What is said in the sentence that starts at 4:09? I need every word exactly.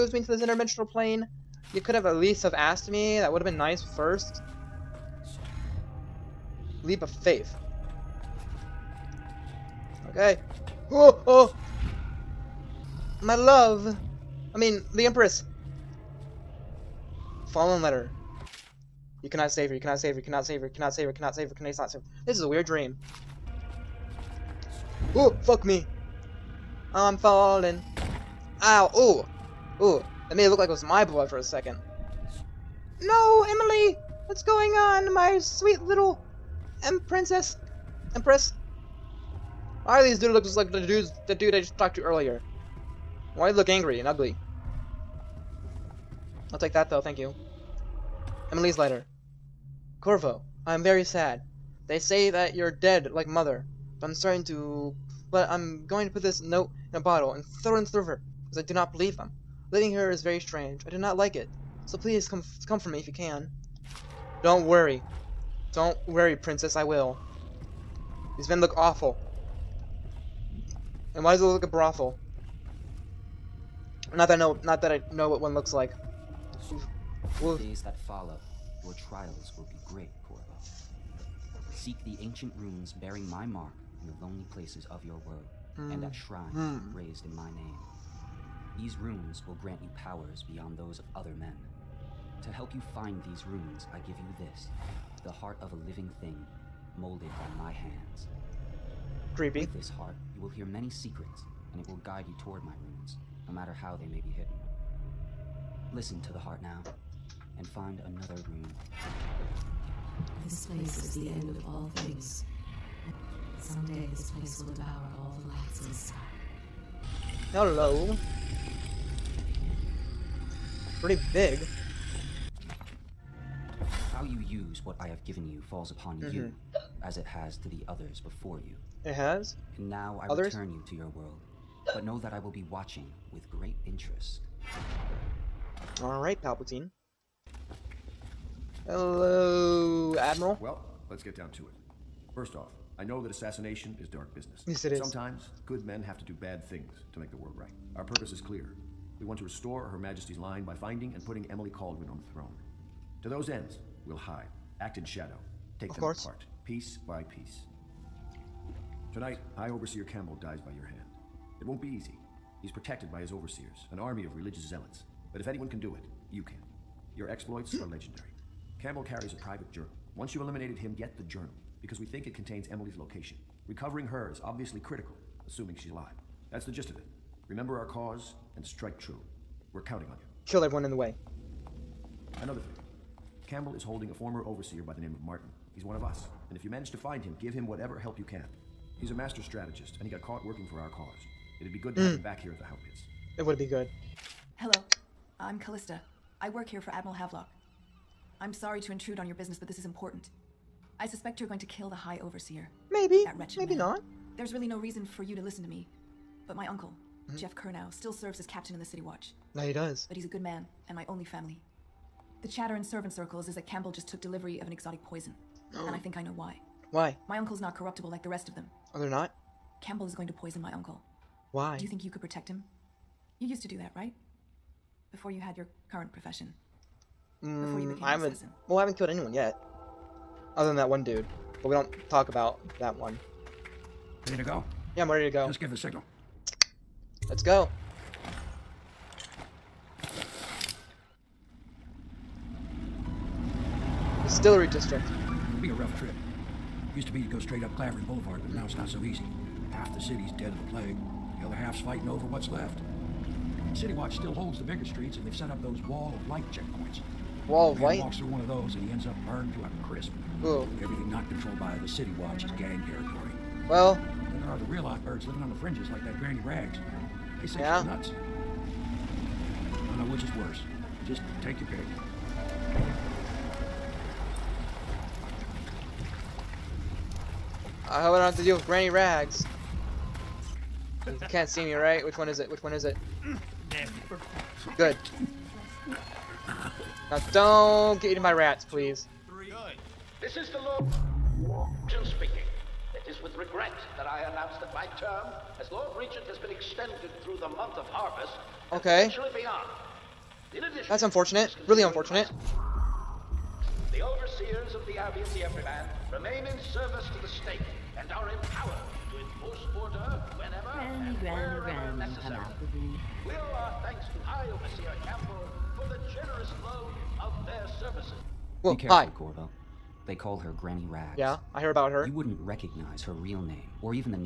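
Half the city's dead of the plague.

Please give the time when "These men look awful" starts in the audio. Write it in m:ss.
1:08.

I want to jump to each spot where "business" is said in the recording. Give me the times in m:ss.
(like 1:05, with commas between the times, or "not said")
2:24, 3:19.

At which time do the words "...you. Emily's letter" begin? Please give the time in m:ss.
0:47.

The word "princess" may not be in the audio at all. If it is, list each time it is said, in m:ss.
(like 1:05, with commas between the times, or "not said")
0:37, 1:06.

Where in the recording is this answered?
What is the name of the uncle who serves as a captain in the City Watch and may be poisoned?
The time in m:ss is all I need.
3:27.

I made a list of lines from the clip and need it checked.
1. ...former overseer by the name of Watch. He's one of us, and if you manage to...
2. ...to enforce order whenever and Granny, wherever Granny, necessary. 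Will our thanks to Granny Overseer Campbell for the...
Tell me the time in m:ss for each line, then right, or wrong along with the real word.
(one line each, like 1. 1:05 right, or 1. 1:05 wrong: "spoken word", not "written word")
1. 3:04 wrong: "Martin", not "Watch"
2. 5:09 wrong: "High", not "Granny".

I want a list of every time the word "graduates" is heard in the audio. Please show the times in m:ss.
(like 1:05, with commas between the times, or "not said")
not said.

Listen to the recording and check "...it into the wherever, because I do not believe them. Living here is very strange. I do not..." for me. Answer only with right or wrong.
wrong.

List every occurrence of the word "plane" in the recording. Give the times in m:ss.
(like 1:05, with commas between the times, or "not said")
0:00.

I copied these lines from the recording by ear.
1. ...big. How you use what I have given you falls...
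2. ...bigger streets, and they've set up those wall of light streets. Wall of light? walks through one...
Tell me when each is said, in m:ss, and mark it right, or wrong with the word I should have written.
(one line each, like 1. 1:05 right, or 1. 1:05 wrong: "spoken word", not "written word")
1. 2:01 right
2. 4:14 wrong: "checkpoints", not "streets".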